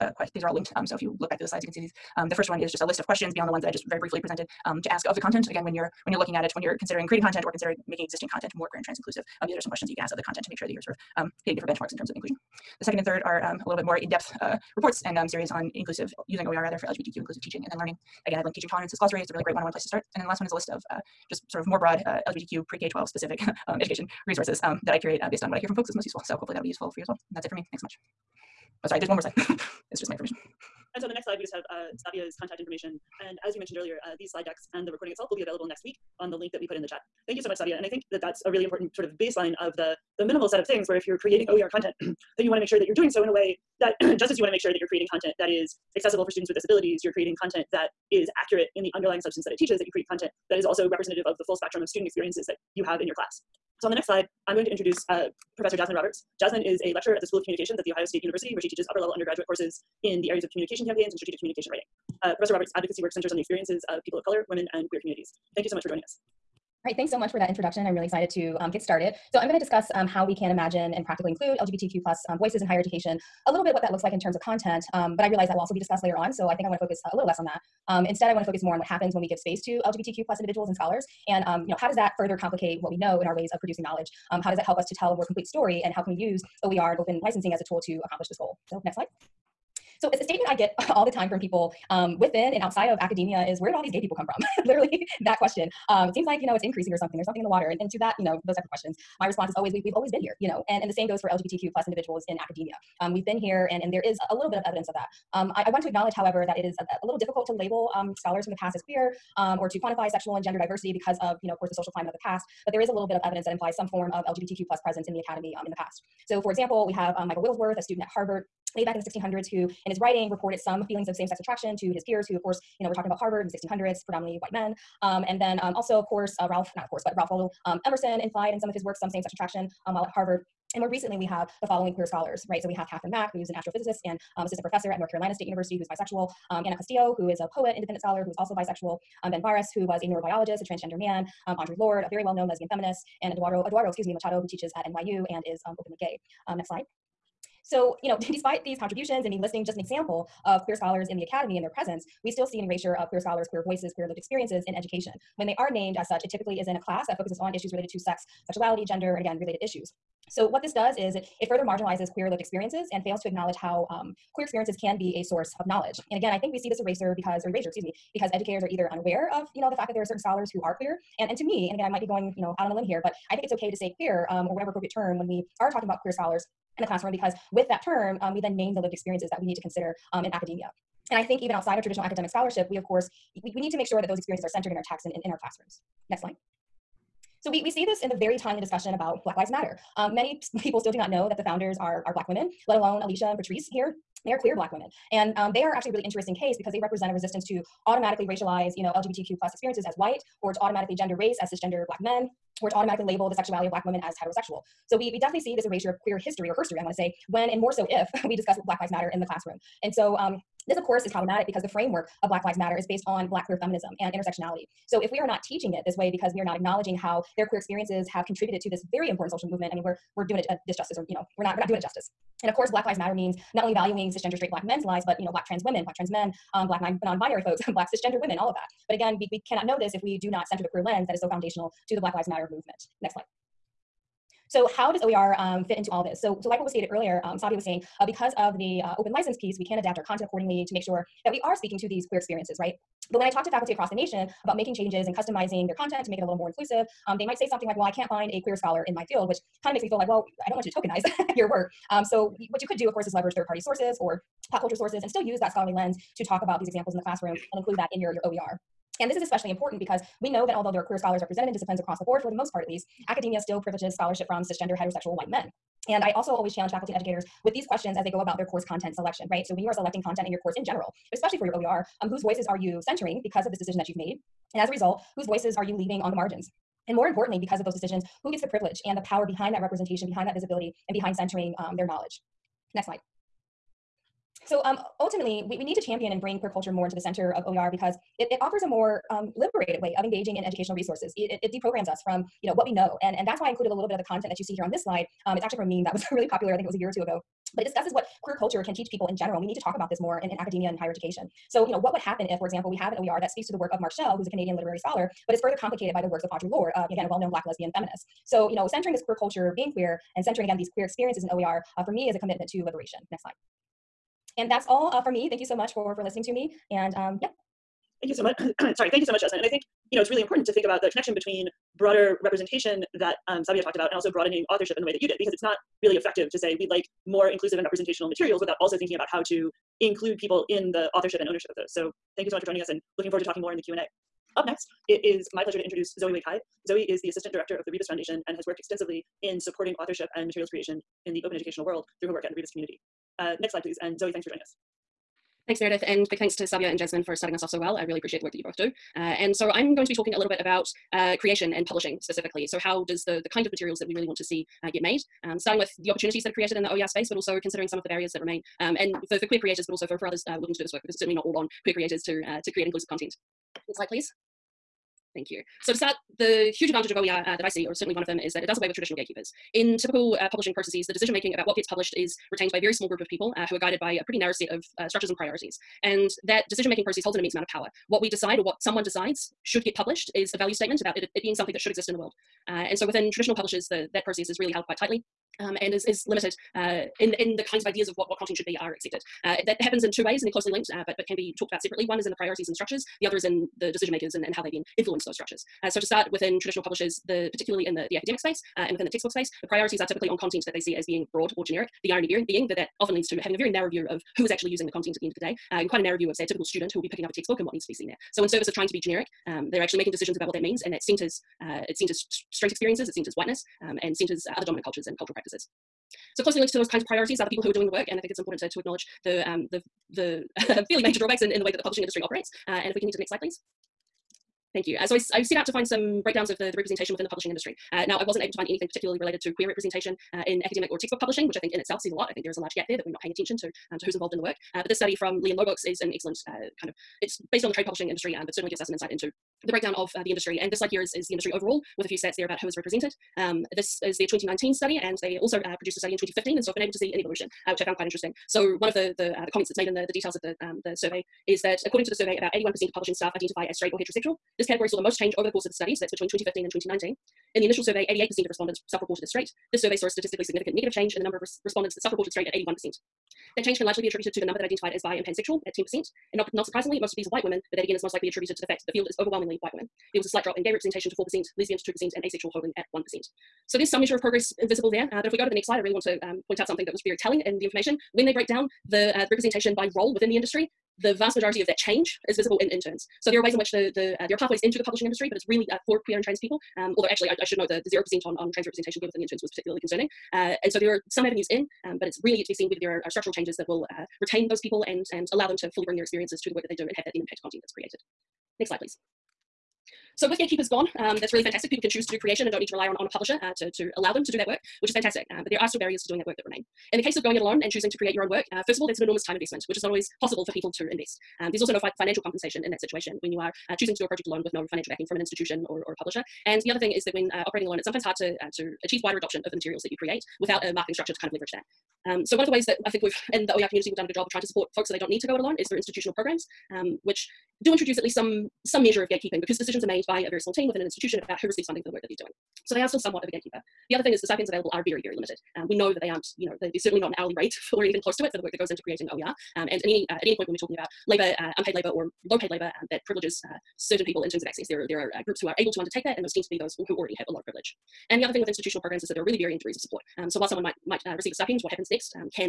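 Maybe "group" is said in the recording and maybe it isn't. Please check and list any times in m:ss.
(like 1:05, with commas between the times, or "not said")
6:12, 9:05.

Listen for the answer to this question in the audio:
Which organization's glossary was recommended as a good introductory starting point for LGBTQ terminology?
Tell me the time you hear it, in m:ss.
0:18.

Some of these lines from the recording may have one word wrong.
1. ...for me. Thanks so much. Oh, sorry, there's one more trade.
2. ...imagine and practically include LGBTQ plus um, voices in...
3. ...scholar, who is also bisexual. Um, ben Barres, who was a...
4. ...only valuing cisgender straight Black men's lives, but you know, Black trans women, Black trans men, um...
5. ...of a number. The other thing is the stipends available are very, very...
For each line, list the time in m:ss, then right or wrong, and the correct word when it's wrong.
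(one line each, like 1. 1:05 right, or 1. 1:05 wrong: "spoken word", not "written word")
1. 0:27 wrong: "slide", not "trade"
2. 1:10 right
3. 2:18 right
4. 3:43 right
5. 8:53 wrong: "gatekeeper", not "number".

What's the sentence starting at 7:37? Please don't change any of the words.
In the initial survey, 88% of respondents self reported as straight.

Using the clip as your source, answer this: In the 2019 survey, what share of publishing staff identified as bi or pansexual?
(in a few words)
10%.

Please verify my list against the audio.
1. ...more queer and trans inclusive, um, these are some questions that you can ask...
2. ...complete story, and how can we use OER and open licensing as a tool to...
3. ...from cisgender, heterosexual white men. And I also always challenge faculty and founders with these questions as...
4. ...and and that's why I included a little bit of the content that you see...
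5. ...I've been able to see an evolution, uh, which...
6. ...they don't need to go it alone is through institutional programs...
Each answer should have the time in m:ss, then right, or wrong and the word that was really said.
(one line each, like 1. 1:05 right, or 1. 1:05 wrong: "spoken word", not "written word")
1. 0:08 right
2. 1:25 right
3. 4:24 wrong: "educators", not "founders"
4. 4:53 right
5. 7:26 right
6. 8:44 right.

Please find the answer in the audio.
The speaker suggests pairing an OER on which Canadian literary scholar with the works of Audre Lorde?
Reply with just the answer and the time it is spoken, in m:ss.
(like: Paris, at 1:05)
Mark Shell, at 5:03.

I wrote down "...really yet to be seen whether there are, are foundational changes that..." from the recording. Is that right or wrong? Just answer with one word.
wrong.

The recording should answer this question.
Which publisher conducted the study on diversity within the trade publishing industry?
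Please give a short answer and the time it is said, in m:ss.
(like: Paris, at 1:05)
Lee and Low Books, at 7:15.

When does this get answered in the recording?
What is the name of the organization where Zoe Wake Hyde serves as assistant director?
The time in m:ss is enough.
5:37.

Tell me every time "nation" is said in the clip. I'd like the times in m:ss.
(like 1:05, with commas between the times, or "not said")
4:03.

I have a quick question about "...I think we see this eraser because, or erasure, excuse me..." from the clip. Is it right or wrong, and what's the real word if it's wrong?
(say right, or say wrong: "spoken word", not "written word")
right.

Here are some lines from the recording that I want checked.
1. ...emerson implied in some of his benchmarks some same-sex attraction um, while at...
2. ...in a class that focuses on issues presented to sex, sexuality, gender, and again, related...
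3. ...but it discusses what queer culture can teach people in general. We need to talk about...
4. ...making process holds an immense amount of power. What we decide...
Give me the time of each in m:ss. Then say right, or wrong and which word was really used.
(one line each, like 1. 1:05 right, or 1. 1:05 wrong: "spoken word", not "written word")
1. 2:07 wrong: "works", not "benchmarks"
2. 2:36 wrong: "related", not "presented"
3. 4:57 right
4. 6:16 right.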